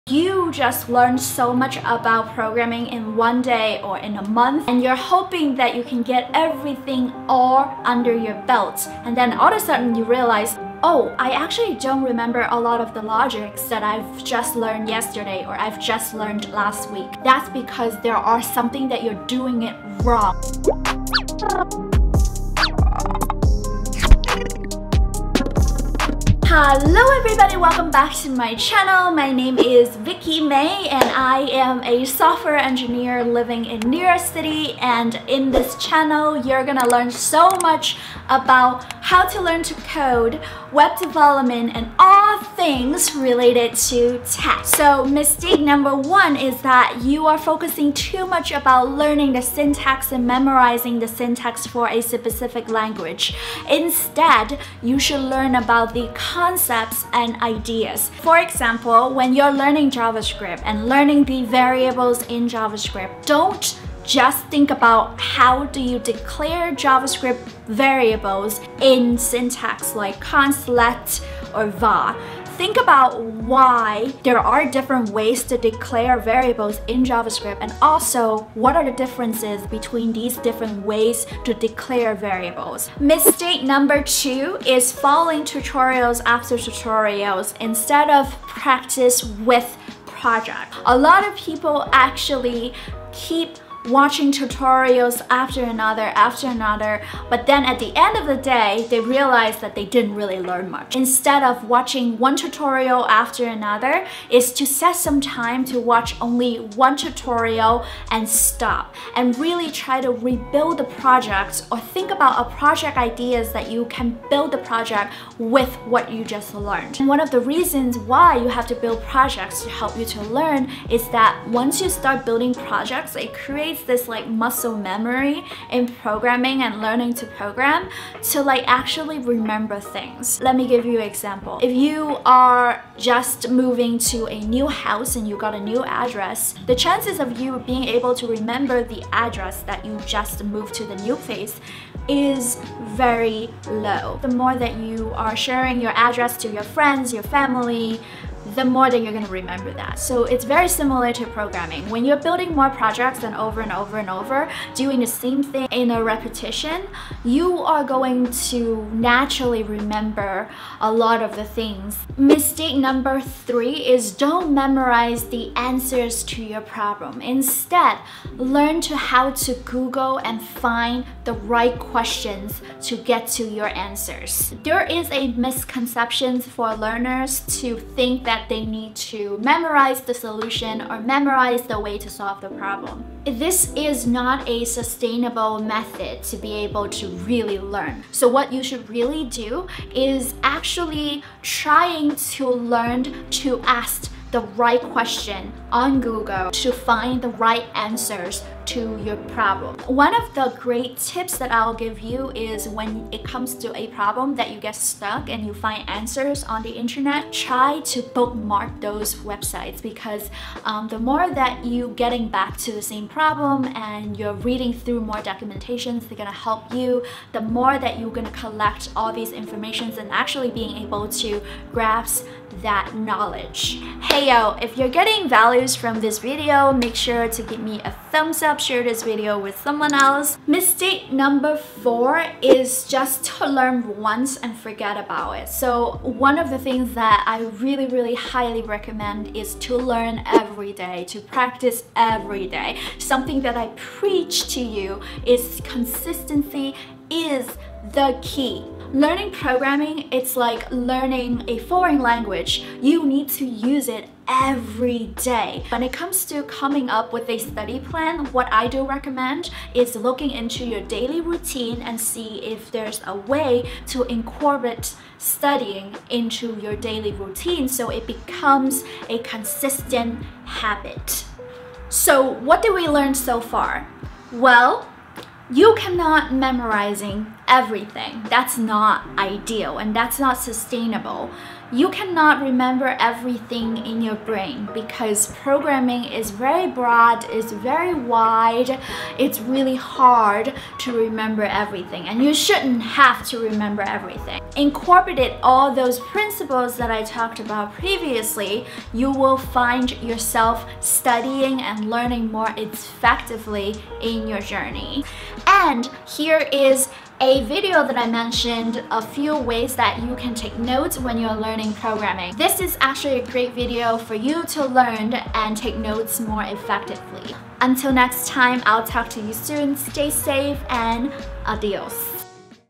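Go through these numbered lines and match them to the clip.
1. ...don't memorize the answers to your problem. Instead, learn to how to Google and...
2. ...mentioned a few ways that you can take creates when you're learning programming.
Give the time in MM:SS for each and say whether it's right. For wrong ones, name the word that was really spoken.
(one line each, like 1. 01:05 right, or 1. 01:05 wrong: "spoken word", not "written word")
1. 02:44 right
2. 05:08 wrong: "notes", not "creates".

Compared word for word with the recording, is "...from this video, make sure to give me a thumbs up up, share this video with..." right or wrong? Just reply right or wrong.
right.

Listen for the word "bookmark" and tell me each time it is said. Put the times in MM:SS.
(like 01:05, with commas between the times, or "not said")
03:28.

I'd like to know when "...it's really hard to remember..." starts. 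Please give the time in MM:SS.
04:49.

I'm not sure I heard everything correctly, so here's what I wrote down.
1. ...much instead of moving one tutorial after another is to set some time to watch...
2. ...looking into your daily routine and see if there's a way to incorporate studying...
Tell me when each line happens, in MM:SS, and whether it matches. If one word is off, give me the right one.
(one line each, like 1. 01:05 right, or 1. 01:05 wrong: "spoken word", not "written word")
1. 01:40 wrong: "watching", not "moving"
2. 04:19 right.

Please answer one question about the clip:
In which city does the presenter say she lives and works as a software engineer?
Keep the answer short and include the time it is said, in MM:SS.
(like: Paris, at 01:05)
New York City, at 00:33.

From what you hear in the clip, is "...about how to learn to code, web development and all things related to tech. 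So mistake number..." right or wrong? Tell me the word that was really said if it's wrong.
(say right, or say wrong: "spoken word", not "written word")
right.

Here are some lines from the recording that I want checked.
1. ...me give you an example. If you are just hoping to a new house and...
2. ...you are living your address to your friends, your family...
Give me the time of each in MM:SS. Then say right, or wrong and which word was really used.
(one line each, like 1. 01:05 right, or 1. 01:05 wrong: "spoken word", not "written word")
1. 02:10 wrong: "moving", not "hoping"
2. 02:24 wrong: "sharing", not "living".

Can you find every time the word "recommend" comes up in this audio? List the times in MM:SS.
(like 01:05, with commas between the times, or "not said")
03:58, 04:18.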